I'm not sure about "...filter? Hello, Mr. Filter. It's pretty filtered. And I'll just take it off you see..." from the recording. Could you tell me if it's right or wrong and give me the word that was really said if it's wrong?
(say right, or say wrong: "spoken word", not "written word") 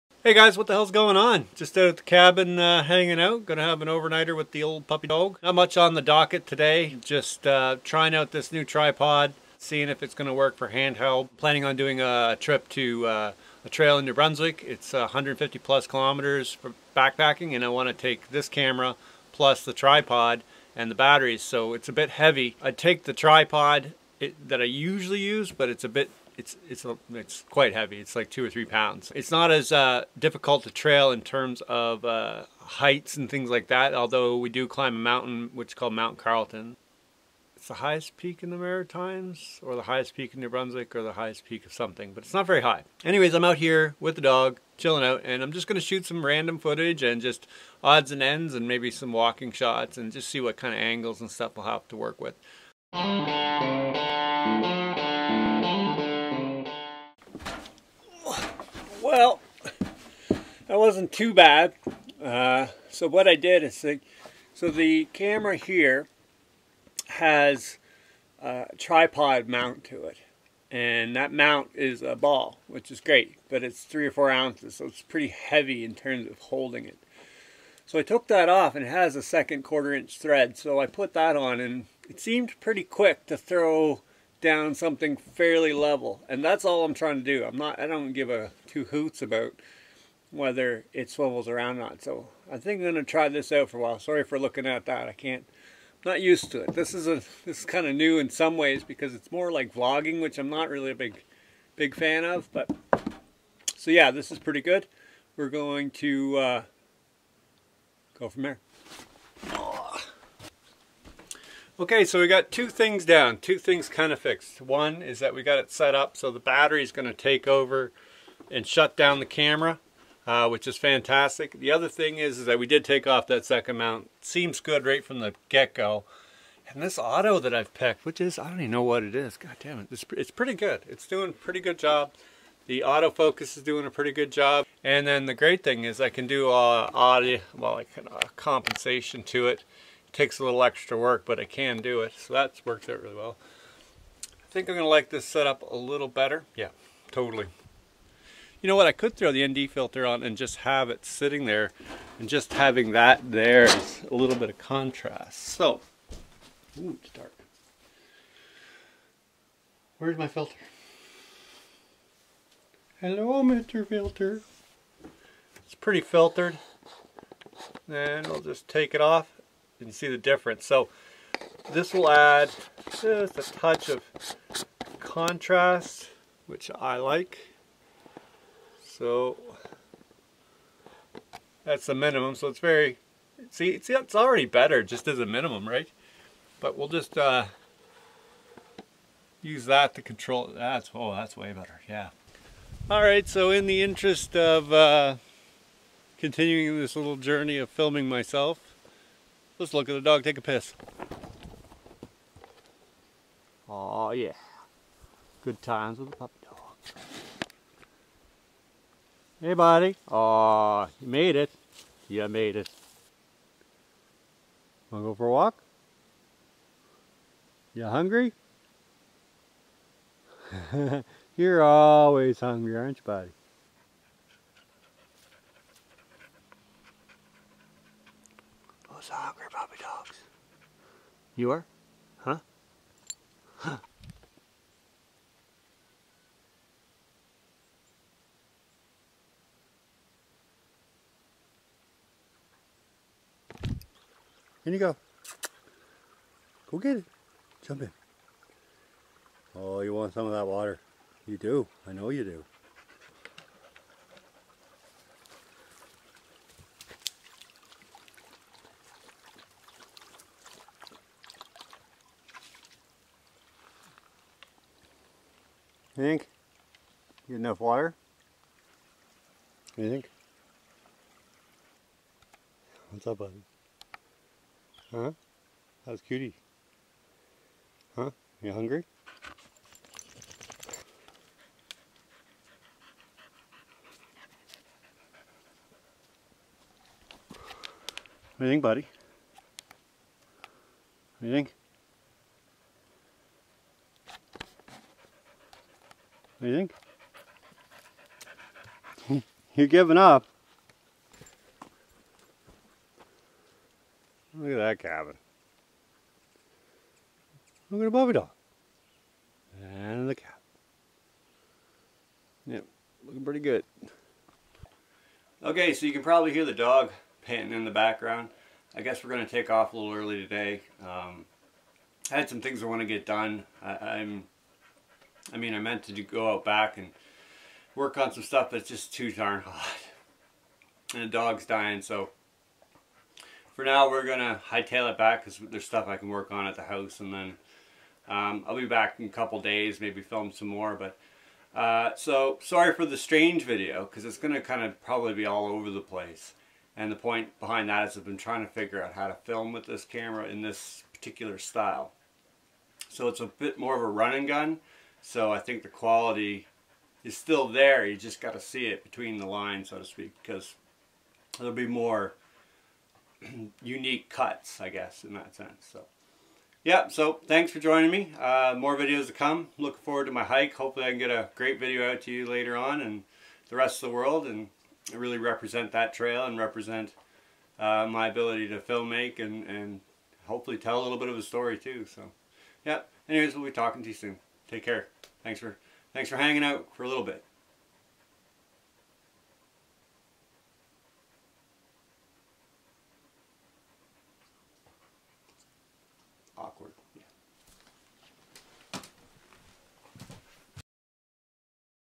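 right.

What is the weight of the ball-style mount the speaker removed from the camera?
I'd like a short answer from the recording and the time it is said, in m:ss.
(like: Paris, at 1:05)
3 or 4 ounces, at 1:13.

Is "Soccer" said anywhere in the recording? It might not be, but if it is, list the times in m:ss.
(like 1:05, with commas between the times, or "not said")
3:49.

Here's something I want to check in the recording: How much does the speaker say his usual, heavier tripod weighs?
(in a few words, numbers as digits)
2 or 3 pounds.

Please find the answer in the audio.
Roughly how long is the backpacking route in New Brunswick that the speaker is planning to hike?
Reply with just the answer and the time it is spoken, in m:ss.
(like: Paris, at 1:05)
150+ kilometers, at 0:14.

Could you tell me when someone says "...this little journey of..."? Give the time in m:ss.
3:16.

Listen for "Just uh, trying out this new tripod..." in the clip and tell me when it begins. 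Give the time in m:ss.
0:07.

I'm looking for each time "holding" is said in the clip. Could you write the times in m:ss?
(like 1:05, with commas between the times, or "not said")
1:16.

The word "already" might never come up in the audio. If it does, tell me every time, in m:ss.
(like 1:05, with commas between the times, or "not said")
3:04.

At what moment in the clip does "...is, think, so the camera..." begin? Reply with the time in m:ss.
1:03.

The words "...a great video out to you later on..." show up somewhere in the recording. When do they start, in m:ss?
6:11.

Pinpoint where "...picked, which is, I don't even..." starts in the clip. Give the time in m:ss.
2:07.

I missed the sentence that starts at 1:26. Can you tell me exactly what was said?
And that's all I'm trying to do.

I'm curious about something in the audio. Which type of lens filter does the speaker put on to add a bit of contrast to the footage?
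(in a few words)
ND filter.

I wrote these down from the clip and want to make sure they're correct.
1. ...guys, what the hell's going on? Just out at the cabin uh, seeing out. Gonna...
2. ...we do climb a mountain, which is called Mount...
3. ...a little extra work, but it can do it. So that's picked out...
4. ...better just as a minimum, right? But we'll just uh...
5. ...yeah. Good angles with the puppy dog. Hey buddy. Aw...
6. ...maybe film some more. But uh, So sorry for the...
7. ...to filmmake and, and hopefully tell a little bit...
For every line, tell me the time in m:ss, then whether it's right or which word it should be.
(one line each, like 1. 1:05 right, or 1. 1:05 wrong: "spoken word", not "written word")
1. 0:00 wrong: "hanging", not "seeing"
2. 0:34 right
3. 2:20 wrong: "worked", not "picked"
4. 3:04 right
5. 3:24 wrong: "times", not "angles"
6. 5:39 right
7. 6:18 right.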